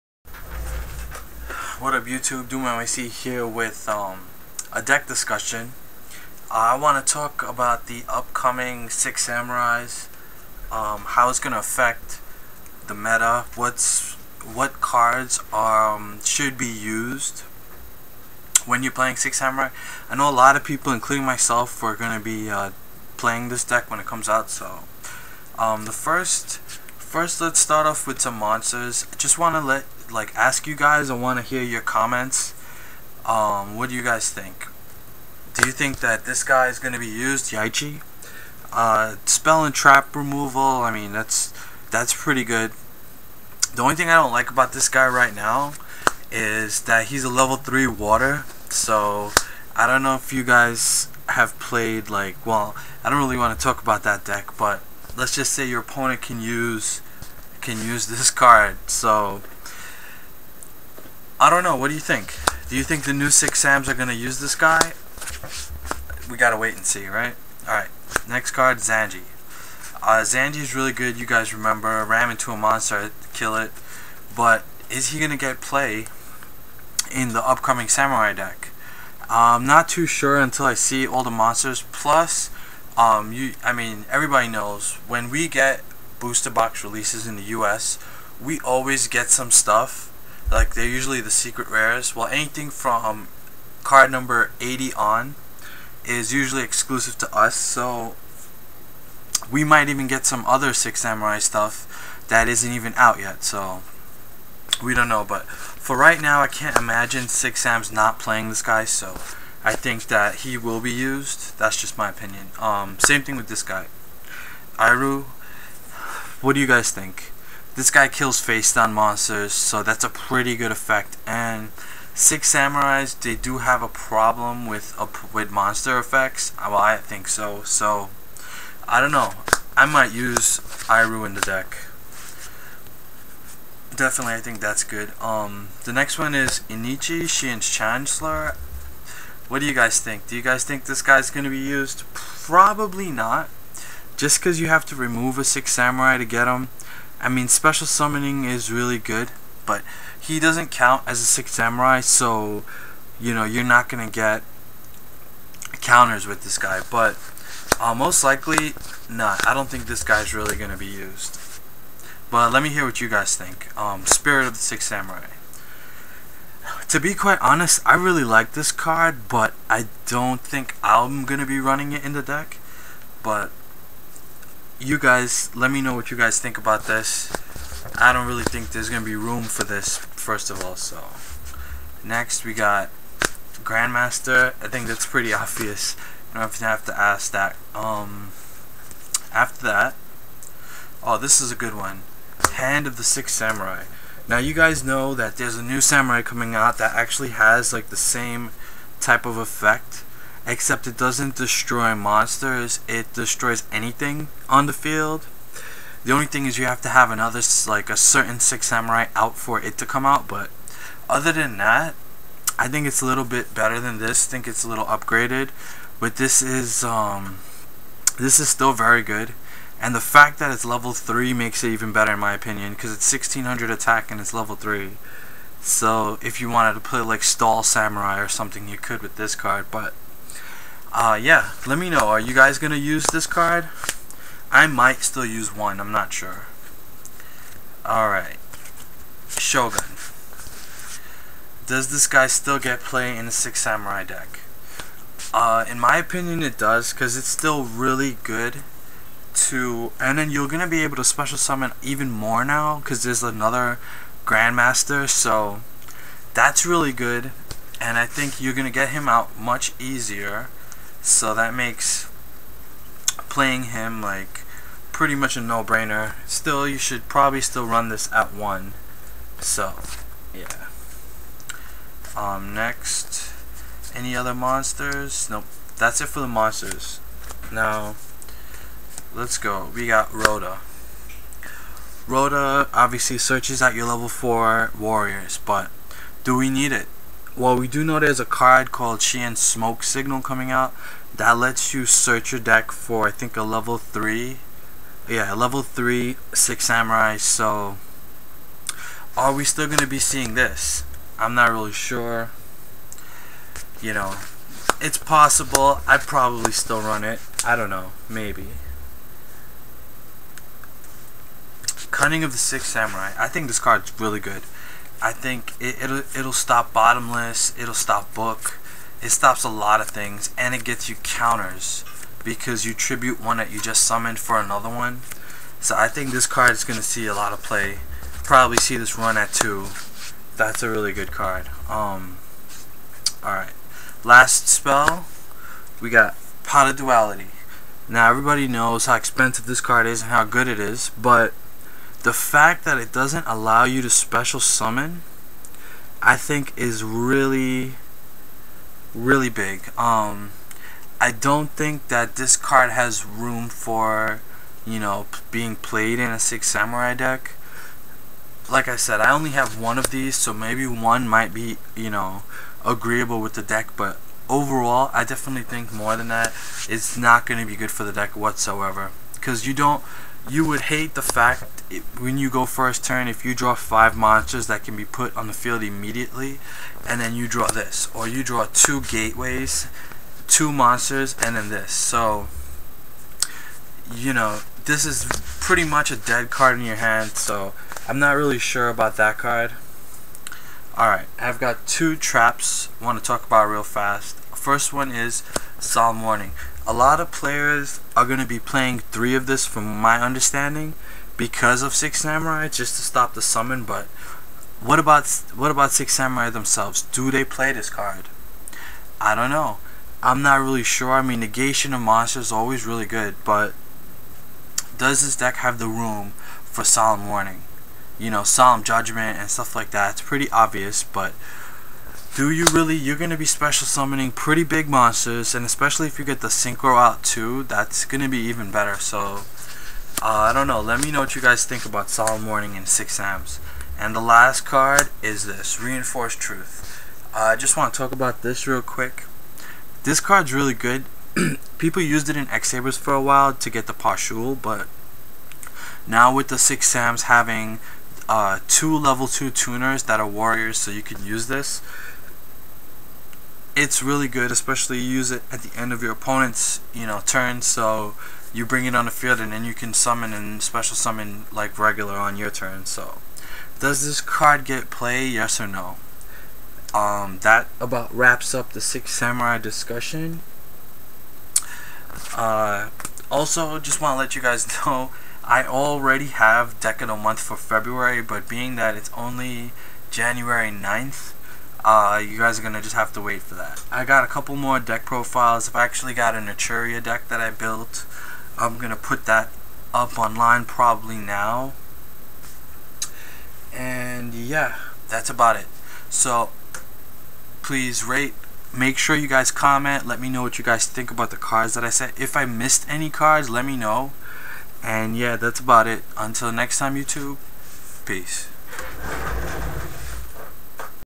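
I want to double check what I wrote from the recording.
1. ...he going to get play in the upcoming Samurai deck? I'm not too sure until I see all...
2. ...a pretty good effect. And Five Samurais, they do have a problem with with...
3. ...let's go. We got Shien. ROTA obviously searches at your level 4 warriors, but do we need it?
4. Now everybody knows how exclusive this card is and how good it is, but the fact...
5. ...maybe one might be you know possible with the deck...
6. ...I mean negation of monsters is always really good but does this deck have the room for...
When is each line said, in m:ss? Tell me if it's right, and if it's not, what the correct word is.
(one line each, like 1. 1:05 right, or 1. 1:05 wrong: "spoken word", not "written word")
1. 1:15 right
2. 2:00 wrong: "Six", not "Five"
3. 4:39 wrong: "ROTA", not "Shien"
4. 5:37 wrong: "expensive", not "exclusive"
5. 6:00 wrong: "agreeable", not "possible"
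6. 6:50 right.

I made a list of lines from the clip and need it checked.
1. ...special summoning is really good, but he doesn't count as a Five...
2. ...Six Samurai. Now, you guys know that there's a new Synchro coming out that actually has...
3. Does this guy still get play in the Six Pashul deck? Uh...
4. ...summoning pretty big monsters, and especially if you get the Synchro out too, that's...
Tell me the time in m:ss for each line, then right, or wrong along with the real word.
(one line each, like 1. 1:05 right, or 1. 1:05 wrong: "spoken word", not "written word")
1. 2:27 wrong: "Six", not "Five"
2. 3:13 wrong: "Samurai", not "Synchro"
3. 4:01 wrong: "Samurai", not "Pashul"
4. 7:03 right.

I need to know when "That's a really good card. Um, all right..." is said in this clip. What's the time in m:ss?
5:30.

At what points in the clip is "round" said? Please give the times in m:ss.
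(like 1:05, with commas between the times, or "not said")
not said.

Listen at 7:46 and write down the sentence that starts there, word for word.
Um, that about wraps up the Six Samurai discussion.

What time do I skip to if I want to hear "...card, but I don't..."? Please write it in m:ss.
2:48.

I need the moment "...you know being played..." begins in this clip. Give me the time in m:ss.
5:54.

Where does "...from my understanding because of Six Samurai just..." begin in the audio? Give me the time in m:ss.
6:39.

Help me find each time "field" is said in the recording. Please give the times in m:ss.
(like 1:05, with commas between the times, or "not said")
3:24, 6:15, 7:38.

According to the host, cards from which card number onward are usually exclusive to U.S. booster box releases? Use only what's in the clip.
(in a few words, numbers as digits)
80.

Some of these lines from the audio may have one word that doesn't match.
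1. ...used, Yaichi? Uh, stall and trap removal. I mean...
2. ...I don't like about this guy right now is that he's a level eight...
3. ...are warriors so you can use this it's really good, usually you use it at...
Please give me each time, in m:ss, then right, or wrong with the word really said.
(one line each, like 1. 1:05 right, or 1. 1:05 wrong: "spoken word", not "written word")
1. 0:37 wrong: "spell", not "stall"
2. 0:44 wrong: "three", not "eight"
3. 7:30 wrong: "especially", not "usually".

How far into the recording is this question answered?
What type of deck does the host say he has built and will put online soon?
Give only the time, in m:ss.
8:06.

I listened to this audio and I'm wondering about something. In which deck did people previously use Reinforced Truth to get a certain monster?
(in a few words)
X-Sabers.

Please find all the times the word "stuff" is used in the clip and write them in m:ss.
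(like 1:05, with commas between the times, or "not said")
1:29, 1:41, 6:59.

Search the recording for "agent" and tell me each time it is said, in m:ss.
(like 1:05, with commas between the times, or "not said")
not said.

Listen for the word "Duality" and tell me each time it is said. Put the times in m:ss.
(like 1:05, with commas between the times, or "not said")
5:36.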